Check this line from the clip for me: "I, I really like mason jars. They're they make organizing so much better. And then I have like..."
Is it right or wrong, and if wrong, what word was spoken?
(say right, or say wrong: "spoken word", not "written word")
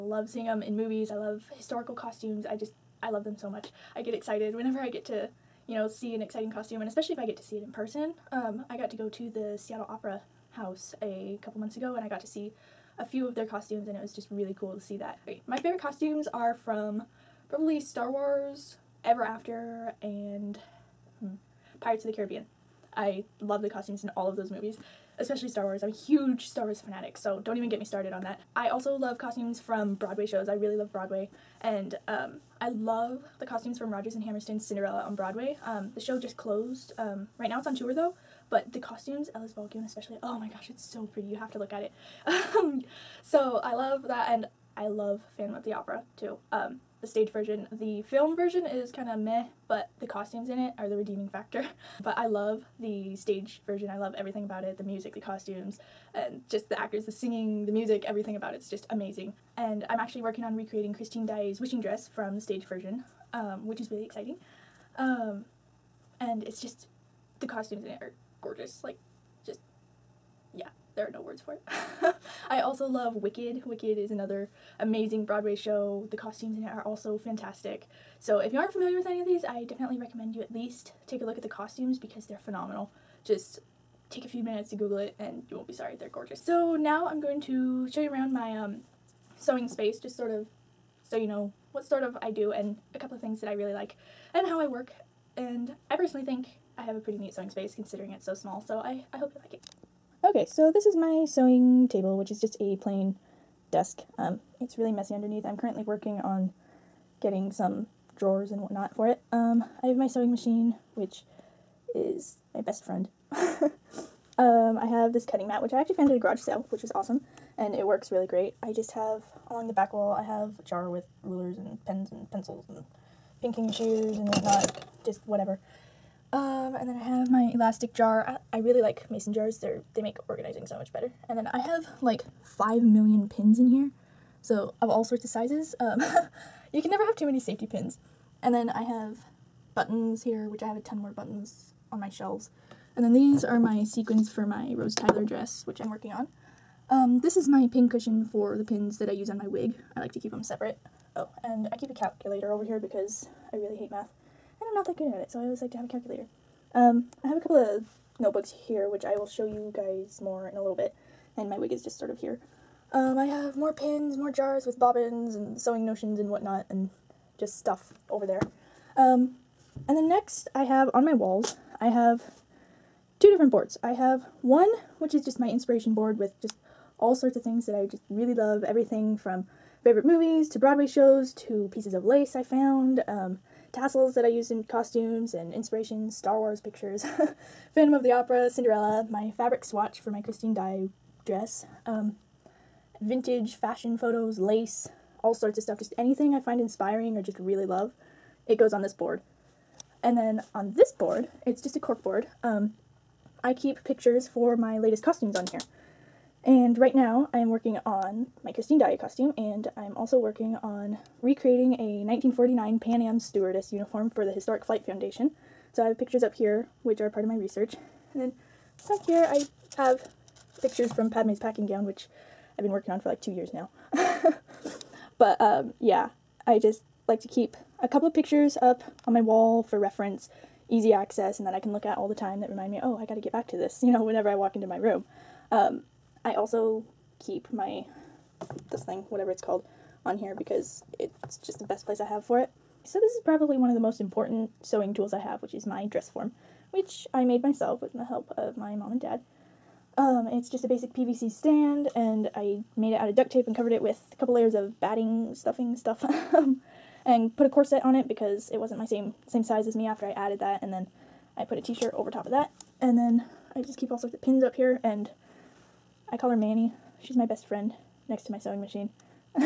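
right.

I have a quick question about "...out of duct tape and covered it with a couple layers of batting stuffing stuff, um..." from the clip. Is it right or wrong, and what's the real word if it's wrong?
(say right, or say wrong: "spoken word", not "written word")
right.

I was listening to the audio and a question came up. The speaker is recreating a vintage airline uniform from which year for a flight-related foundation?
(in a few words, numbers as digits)
1949.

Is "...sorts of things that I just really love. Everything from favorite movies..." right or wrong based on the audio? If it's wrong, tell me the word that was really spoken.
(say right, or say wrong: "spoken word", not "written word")
right.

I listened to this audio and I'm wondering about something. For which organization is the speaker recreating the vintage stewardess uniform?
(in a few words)
Historic Flight Foundation.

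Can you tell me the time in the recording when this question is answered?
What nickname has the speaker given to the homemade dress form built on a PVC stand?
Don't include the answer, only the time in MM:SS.
04:26.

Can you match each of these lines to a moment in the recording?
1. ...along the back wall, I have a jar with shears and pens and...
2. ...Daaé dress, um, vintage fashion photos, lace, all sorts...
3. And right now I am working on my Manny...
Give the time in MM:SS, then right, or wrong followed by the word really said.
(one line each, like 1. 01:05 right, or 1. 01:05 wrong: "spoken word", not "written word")
1. 01:59 wrong: "rulers", not "shears"
2. 03:10 right
3. 03:26 wrong: "Christine", not "Manny".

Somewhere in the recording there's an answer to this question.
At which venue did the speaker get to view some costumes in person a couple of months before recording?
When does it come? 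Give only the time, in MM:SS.
00:09.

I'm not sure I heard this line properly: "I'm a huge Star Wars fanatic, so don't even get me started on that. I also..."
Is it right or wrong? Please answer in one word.
right.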